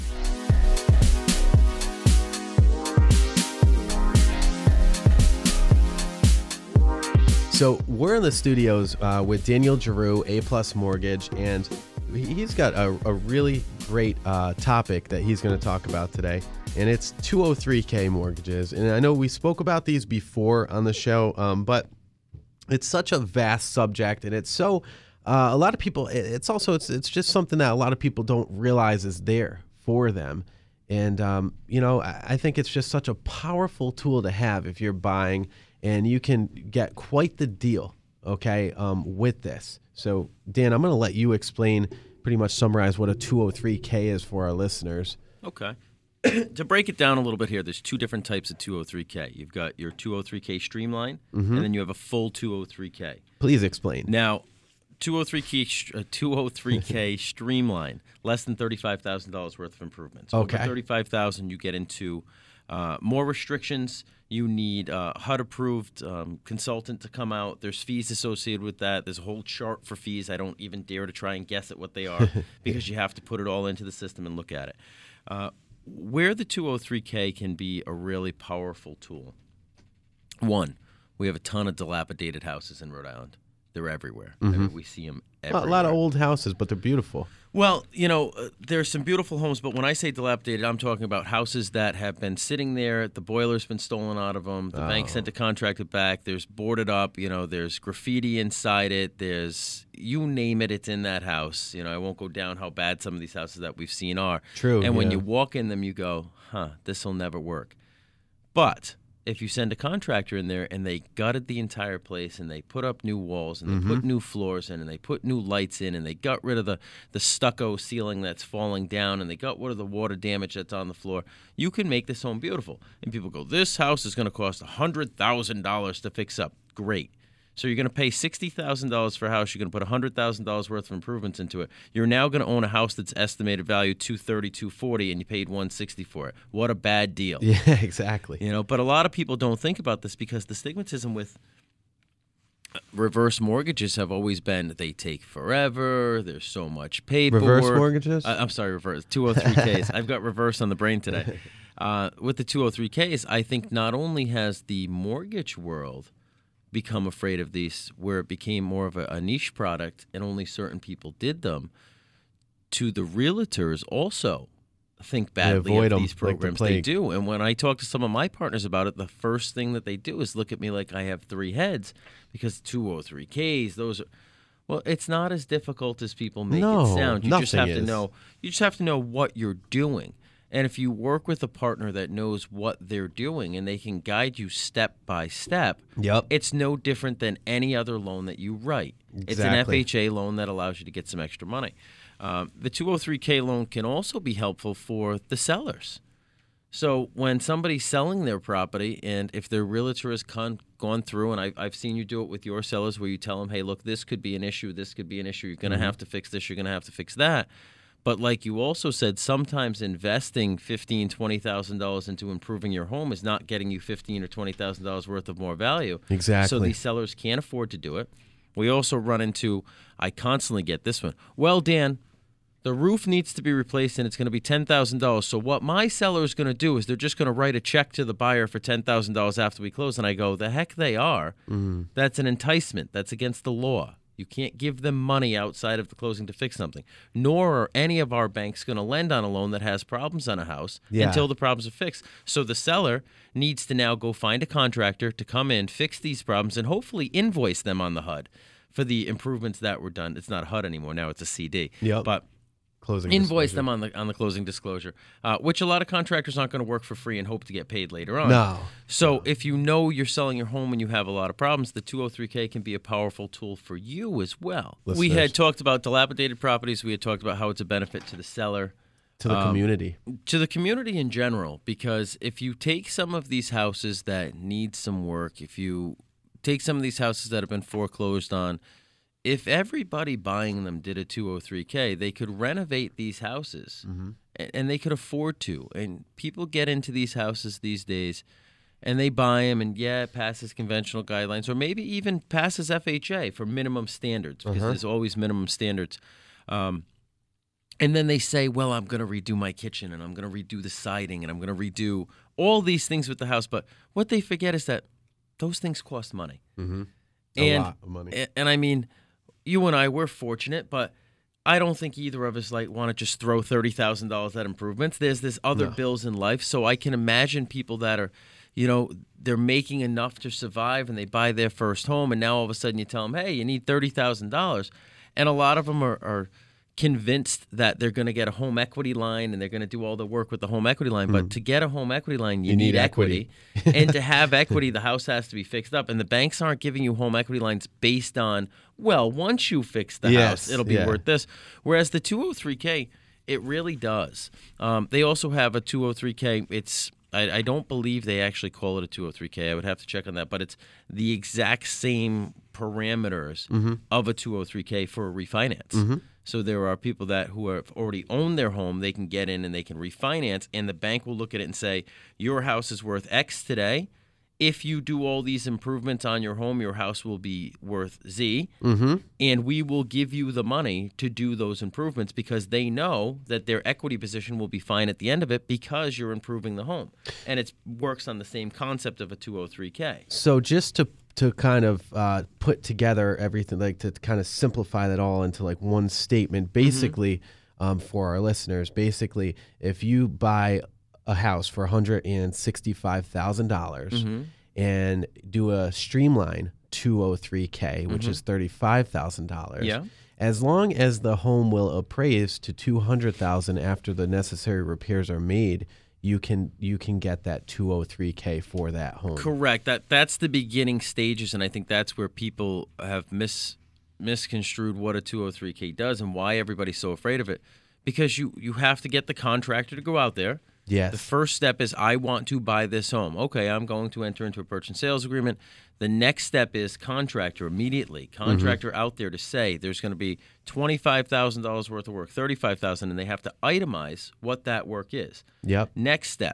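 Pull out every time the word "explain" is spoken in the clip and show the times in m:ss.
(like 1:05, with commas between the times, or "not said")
0:41, 0:53.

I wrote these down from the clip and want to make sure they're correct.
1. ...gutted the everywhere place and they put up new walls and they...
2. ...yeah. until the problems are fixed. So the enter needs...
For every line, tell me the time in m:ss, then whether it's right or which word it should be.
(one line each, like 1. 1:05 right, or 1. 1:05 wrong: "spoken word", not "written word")
1. 1:51 wrong: "entire", not "everywhere"
2. 4:00 wrong: "seller", not "enter".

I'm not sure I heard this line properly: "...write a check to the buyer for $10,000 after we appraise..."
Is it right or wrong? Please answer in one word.
wrong.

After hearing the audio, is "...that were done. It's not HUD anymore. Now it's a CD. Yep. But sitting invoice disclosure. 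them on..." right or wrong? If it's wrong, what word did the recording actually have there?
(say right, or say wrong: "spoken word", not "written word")
wrong: "closing", not "sitting".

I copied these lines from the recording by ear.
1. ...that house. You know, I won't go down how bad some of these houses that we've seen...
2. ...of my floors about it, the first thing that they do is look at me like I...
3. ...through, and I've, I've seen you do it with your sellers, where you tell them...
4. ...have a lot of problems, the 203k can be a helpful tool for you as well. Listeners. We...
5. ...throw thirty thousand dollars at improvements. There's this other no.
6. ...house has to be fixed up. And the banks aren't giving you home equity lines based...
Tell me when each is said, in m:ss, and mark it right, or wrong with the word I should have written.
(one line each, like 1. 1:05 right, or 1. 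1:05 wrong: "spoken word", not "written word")
1. 1:41 right
2. 2:48 wrong: "partners", not "floors"
3. 3:21 right
4. 4:20 wrong: "powerful", not "helpful"
5. 5:13 right
6. 5:34 right.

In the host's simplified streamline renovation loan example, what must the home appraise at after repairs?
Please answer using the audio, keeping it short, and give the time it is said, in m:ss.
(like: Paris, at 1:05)
200,000, at 6:42.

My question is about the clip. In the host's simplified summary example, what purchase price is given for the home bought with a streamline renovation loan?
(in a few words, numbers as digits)
$165,000.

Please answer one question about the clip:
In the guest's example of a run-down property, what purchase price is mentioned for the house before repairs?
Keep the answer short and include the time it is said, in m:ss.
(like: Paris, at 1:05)
$60,000, at 2:08.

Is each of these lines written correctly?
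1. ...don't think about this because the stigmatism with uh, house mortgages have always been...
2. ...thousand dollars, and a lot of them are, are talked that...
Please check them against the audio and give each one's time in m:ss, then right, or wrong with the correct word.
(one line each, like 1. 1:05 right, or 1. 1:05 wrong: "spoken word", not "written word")
1. 2:19 wrong: "reverse", not "house"
2. 5:23 wrong: "convinced", not "talked".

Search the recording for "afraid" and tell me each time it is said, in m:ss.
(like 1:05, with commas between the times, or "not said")
2:37, 6:56.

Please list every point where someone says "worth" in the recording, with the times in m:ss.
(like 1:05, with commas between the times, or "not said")
0:59, 2:10, 3:35, 5:40, 6:02, 6:07, 7:11.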